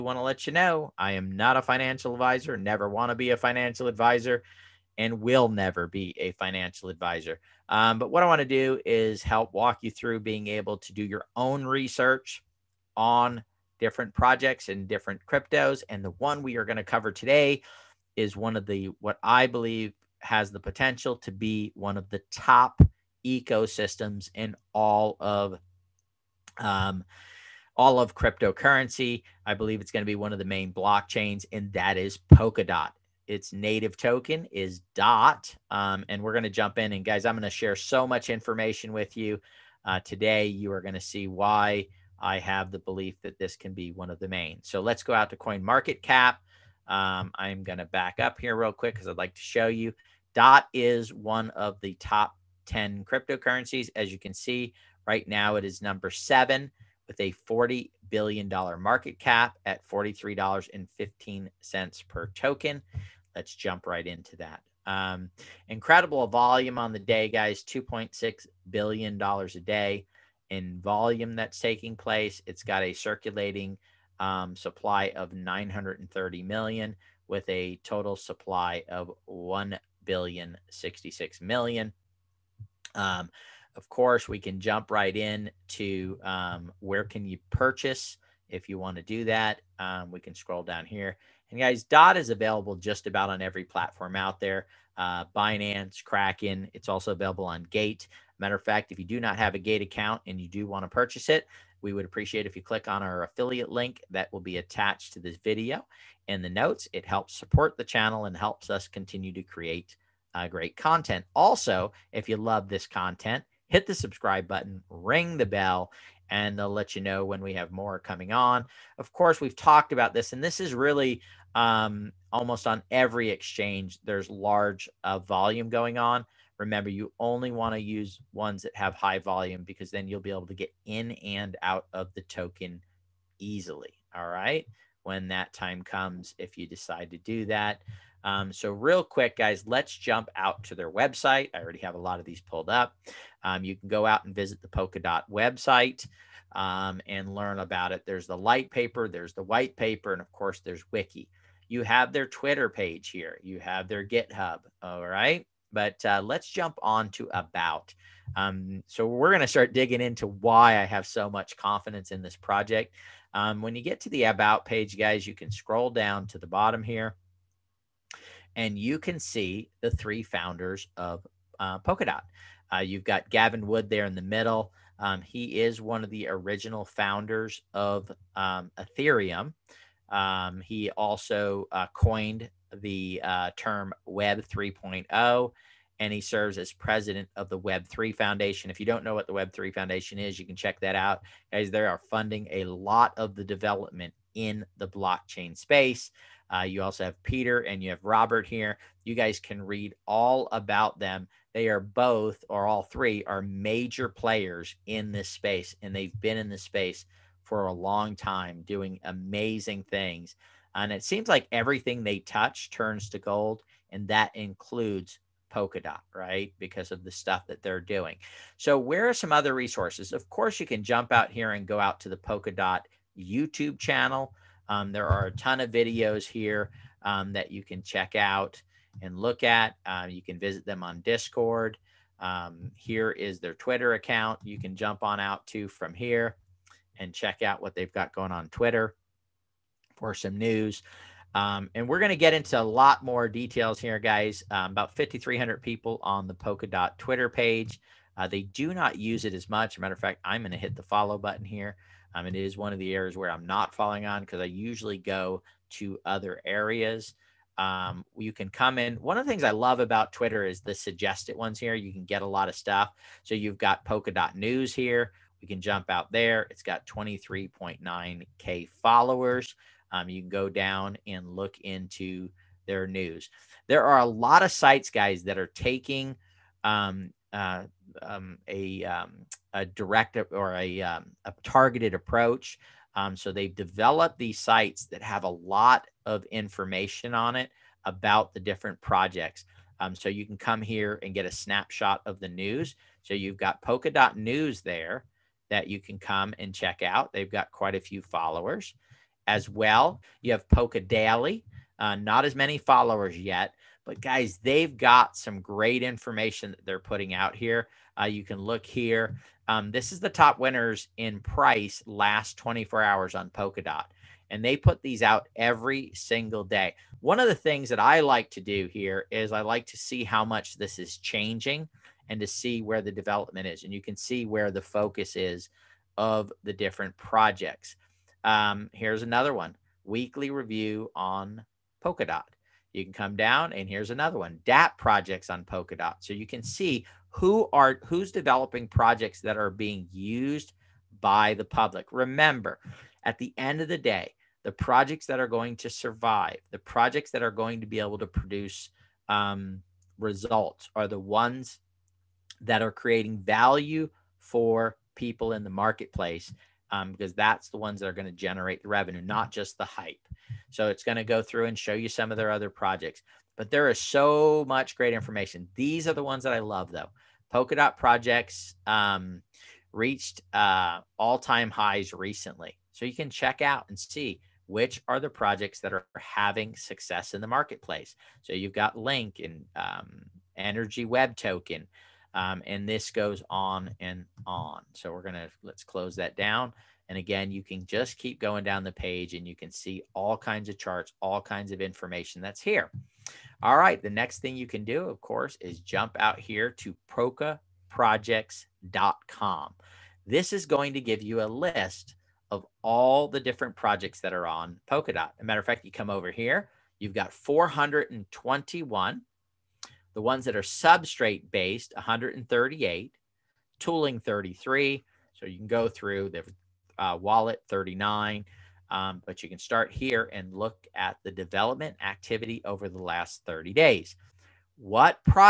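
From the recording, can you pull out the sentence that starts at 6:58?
Um, but you can start here and look at the development activity over the last 30 days.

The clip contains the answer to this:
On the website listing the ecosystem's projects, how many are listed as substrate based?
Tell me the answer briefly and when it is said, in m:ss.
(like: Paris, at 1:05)
138, at 6:51.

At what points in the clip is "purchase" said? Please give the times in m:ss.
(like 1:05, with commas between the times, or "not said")
1:27, 1:40.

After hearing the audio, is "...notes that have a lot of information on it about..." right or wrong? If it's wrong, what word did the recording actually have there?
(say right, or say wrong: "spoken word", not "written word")
wrong: "sites", not "notes".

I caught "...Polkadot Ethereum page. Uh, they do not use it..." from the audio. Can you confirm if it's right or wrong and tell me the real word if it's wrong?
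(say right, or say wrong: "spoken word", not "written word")
wrong: "Twitter", not "Ethereum".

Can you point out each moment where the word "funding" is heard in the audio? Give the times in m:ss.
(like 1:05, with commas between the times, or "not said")
3:12.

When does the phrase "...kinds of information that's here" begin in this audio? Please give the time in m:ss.
6:31.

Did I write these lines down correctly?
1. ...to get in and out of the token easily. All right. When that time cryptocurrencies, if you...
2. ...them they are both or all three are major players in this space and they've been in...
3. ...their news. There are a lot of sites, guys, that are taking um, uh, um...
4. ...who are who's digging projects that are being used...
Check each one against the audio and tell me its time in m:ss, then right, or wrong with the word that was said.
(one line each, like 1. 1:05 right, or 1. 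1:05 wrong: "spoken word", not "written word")
1. 2:10 wrong: "comes", not "cryptocurrencies"
2. 3:20 right
3. 4:32 right
4. 5:37 wrong: "developing", not "digging".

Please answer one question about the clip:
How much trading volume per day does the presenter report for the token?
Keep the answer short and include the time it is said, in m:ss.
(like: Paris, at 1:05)
$2.6 billion, at 1:07.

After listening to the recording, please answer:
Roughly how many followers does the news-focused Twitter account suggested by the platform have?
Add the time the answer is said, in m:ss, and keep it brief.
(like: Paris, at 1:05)
23.9K, at 4:26.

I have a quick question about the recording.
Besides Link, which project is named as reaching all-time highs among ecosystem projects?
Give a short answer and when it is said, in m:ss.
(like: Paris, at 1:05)
Energy Web Token, at 6:20.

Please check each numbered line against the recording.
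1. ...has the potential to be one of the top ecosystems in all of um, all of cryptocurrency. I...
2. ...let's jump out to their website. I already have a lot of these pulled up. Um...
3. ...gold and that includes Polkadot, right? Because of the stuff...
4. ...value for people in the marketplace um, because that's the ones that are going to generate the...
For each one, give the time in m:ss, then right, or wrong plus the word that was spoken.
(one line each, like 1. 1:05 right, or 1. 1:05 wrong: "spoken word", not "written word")
1. 0:20 right
2. 2:19 right
3. 3:33 right
4. 5:53 right.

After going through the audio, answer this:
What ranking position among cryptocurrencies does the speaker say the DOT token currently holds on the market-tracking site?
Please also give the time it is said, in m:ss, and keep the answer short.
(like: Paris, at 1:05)
7, at 0:55.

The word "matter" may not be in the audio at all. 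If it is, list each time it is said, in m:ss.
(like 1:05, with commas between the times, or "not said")
1:38, 4:09, 6:45.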